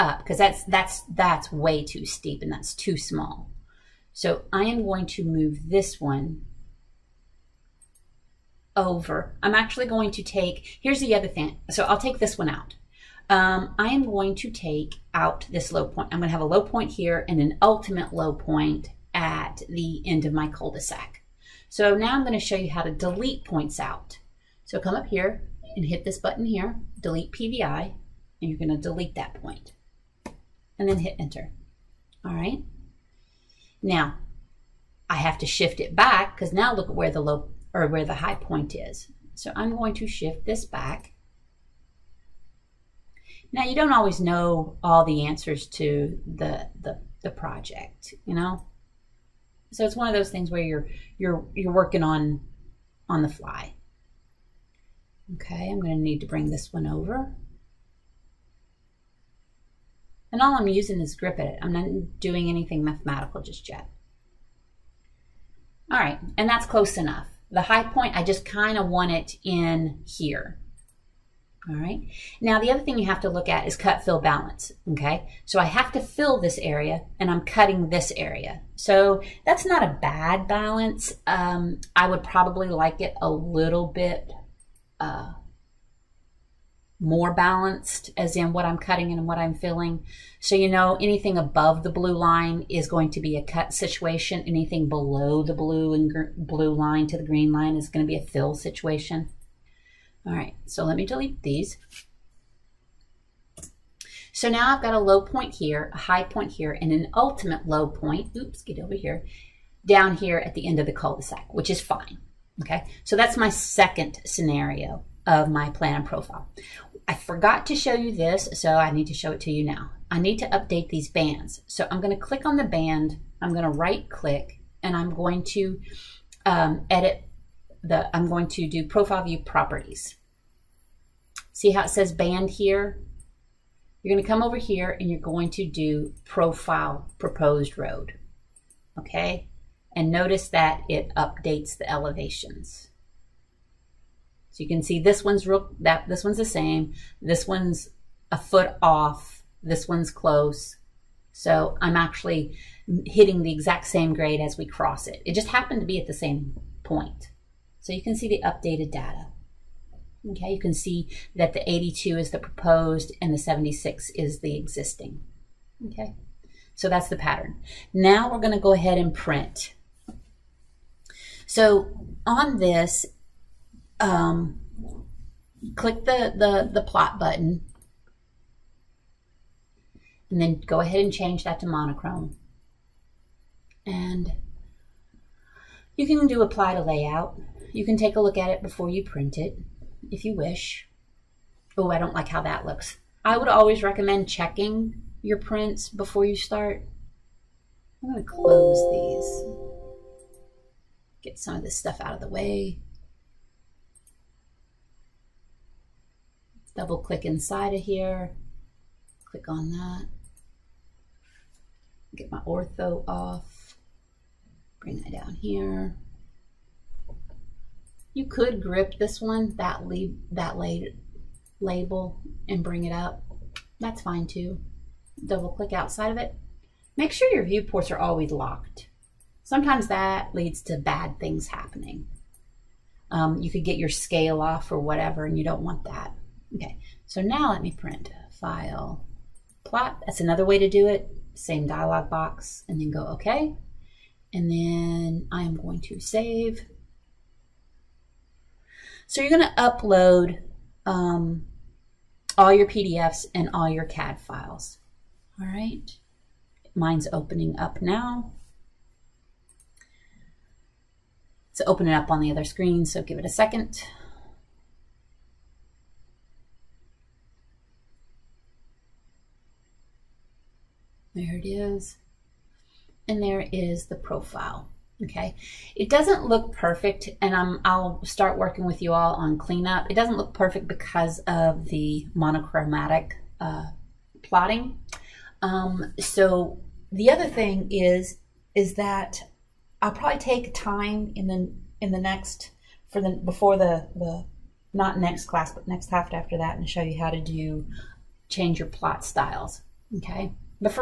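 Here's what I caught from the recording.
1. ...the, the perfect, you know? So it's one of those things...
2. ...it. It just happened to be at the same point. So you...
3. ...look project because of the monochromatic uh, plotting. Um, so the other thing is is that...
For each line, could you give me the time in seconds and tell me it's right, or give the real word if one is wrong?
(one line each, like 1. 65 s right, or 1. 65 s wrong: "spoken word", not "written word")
1. 46 s wrong: "project", not "perfect"
2. 155 s right
3. 280 s wrong: "perfect", not "project".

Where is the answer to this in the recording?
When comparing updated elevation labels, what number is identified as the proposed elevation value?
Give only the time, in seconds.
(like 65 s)
161 s.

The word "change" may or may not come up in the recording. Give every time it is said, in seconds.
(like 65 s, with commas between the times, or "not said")
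181 s, 298 s.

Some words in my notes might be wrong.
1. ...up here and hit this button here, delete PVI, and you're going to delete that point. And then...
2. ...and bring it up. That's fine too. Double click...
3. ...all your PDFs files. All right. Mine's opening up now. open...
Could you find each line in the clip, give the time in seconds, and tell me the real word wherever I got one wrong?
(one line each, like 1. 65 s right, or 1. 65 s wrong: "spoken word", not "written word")
1. 24 s right
2. 222 s right
3. 253 s wrong: "CAD", not "PDFs".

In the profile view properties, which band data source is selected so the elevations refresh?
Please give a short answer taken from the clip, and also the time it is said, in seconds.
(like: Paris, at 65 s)
Profile proposed road, at 136 s.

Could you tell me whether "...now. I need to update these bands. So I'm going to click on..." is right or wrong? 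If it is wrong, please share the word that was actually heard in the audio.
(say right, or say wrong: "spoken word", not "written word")
right.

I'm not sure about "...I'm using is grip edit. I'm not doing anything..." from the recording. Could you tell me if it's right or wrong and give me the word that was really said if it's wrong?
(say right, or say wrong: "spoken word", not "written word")
right.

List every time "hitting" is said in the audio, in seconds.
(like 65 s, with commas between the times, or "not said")
153 s.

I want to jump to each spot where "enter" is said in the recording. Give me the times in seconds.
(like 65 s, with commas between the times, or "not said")
31 s.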